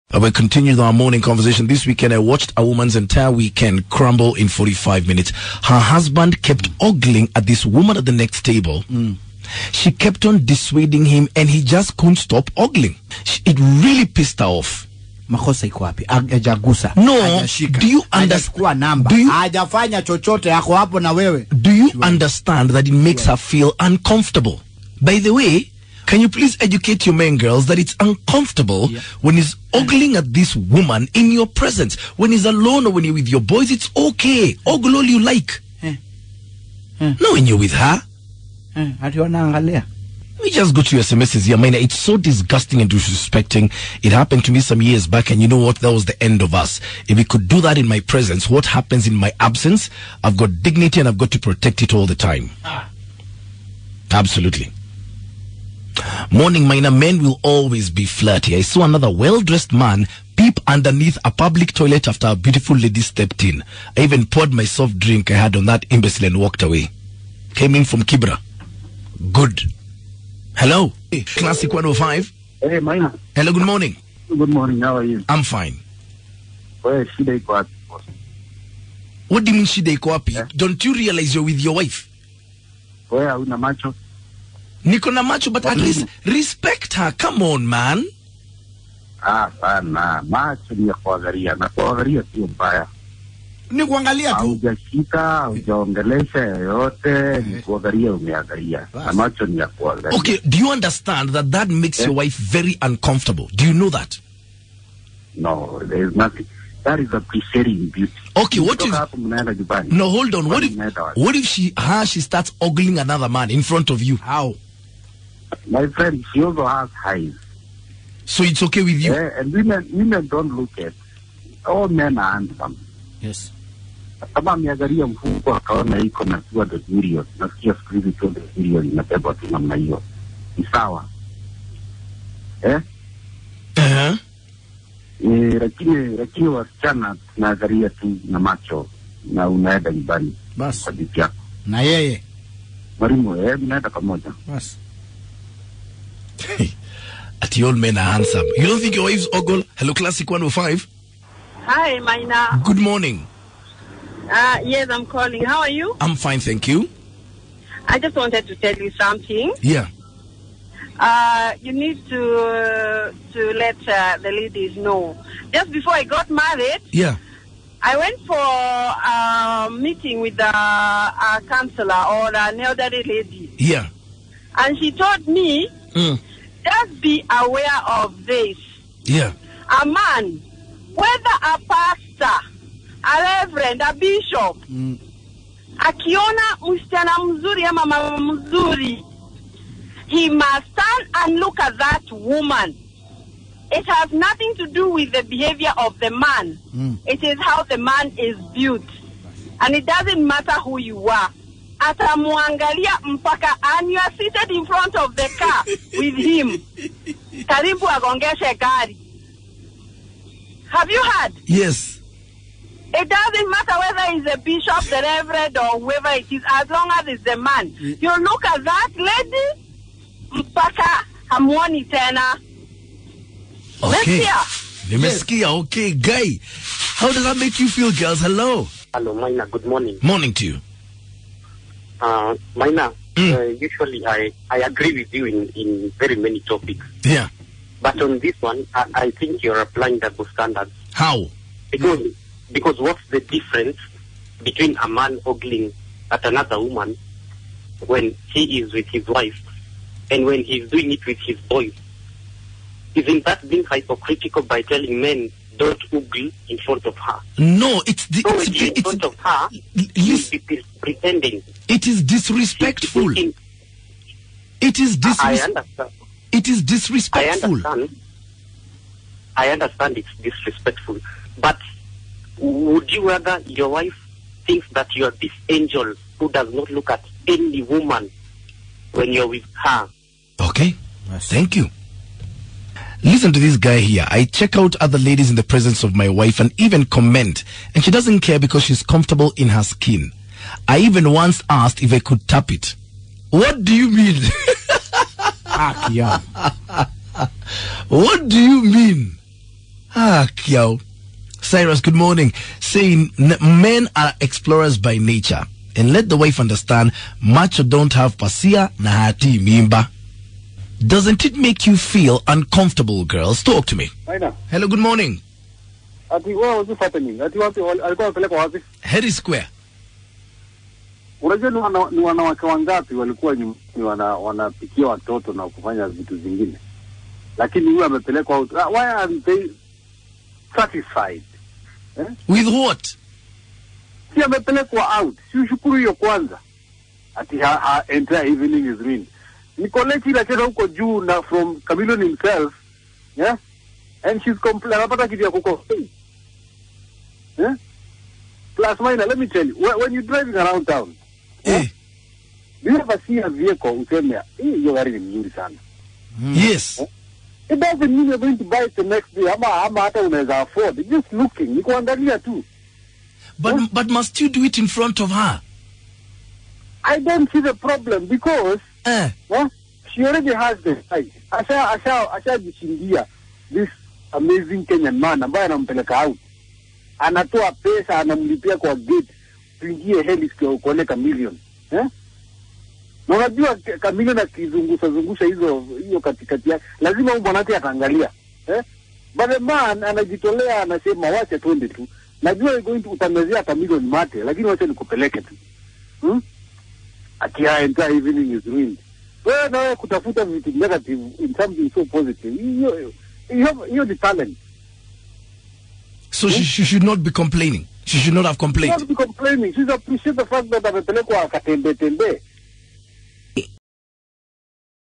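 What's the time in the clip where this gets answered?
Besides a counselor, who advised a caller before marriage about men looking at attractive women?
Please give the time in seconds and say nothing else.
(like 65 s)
172 s.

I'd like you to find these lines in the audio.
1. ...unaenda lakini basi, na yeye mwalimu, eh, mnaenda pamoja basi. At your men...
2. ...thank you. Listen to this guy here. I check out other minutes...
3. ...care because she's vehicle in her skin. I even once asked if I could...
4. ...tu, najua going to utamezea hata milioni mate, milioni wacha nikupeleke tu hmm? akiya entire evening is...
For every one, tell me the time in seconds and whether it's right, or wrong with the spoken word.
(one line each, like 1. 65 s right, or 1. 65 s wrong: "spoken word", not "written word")
1. 139 s wrong: "nyumbani", not "lakini"
2. 281 s wrong: "ladies", not "minutes"
3. 288 s wrong: "comfortable", not "vehicle"
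4. 391 s wrong: "lakini", not "milioni".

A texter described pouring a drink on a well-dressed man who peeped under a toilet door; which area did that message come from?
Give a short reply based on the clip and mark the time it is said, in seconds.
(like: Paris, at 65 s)
Kibra, at 68 s.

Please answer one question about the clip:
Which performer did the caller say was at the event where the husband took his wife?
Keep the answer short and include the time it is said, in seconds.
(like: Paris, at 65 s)
Chameleon, at 341 s.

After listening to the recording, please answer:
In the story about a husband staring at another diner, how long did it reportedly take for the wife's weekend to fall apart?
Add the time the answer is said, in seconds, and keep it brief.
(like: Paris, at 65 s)
45 minutes, at 4 s.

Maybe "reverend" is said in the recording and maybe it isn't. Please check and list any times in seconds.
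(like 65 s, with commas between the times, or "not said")
183 s, 215 s.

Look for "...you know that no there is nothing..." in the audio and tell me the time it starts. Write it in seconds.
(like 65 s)
103 s.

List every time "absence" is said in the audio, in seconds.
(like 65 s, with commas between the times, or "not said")
49 s.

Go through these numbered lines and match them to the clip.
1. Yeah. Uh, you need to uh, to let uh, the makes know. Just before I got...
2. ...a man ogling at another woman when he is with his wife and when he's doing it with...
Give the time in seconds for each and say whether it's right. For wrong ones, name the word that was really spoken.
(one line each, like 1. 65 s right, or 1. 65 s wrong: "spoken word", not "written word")
1. 159 s wrong: "ladies", not "makes"
2. 244 s right.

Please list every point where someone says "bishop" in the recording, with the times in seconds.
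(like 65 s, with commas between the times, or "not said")
183 s, 214 s.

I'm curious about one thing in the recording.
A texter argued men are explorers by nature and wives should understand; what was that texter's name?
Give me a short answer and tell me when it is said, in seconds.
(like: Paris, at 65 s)
Cyrus, at 301 s.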